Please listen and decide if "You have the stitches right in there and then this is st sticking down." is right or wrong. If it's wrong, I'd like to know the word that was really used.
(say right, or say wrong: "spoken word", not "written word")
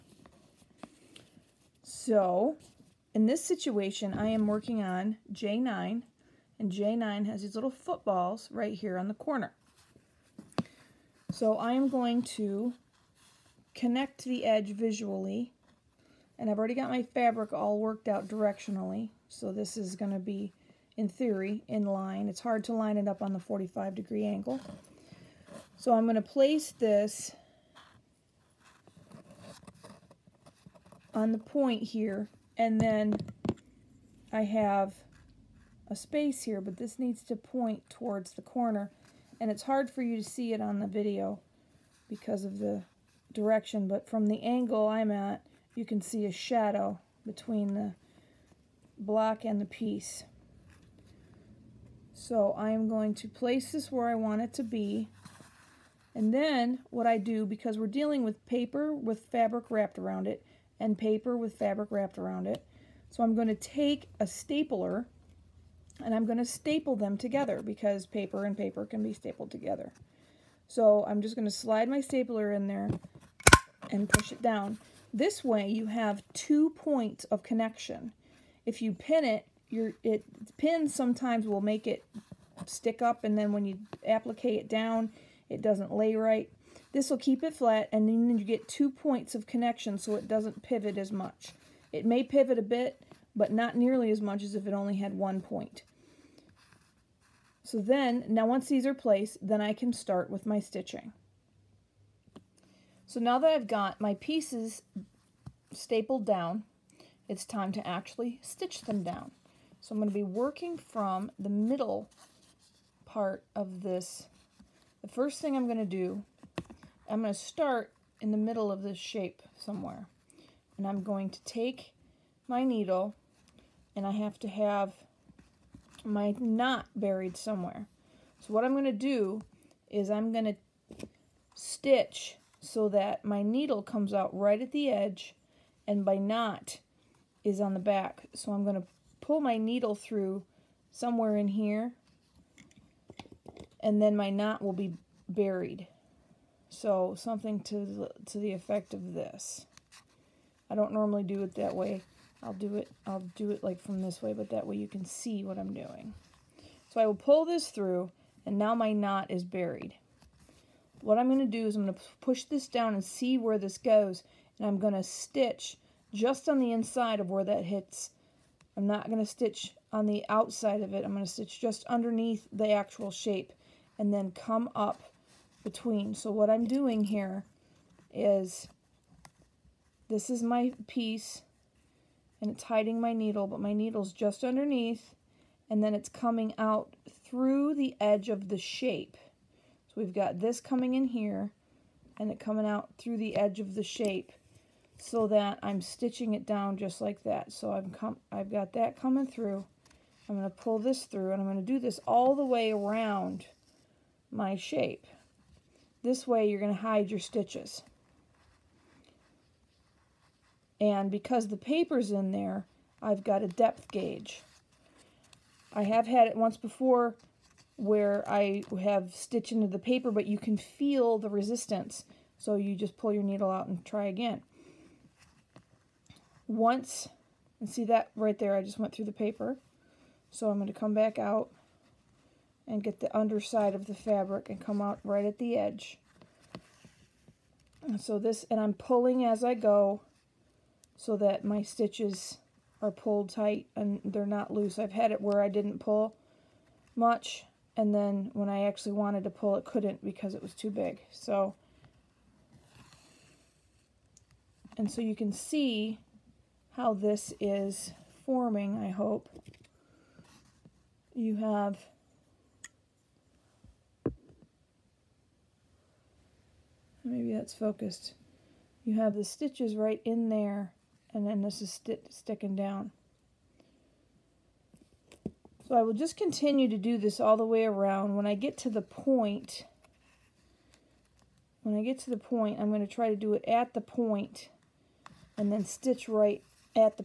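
right.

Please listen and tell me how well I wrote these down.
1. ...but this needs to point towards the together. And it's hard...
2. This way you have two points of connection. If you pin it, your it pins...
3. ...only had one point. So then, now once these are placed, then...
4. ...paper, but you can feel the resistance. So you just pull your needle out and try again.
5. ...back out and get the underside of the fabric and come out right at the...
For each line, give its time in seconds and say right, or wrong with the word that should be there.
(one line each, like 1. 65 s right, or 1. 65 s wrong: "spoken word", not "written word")
1. 36 s wrong: "corner", not "together"
2. 75 s right
3. 94 s right
4. 219 s right
5. 230 s right.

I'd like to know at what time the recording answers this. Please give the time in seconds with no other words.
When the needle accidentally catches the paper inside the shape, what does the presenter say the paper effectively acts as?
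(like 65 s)
213 s.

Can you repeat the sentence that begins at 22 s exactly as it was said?
It's hard to line it up on the 45 degree angle.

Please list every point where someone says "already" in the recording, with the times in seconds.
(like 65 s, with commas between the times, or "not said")
16 s.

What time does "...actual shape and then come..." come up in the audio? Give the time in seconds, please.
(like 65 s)
172 s.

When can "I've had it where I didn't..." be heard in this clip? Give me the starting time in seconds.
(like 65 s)
244 s.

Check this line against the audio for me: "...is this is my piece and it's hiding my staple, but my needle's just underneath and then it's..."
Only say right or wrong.
wrong.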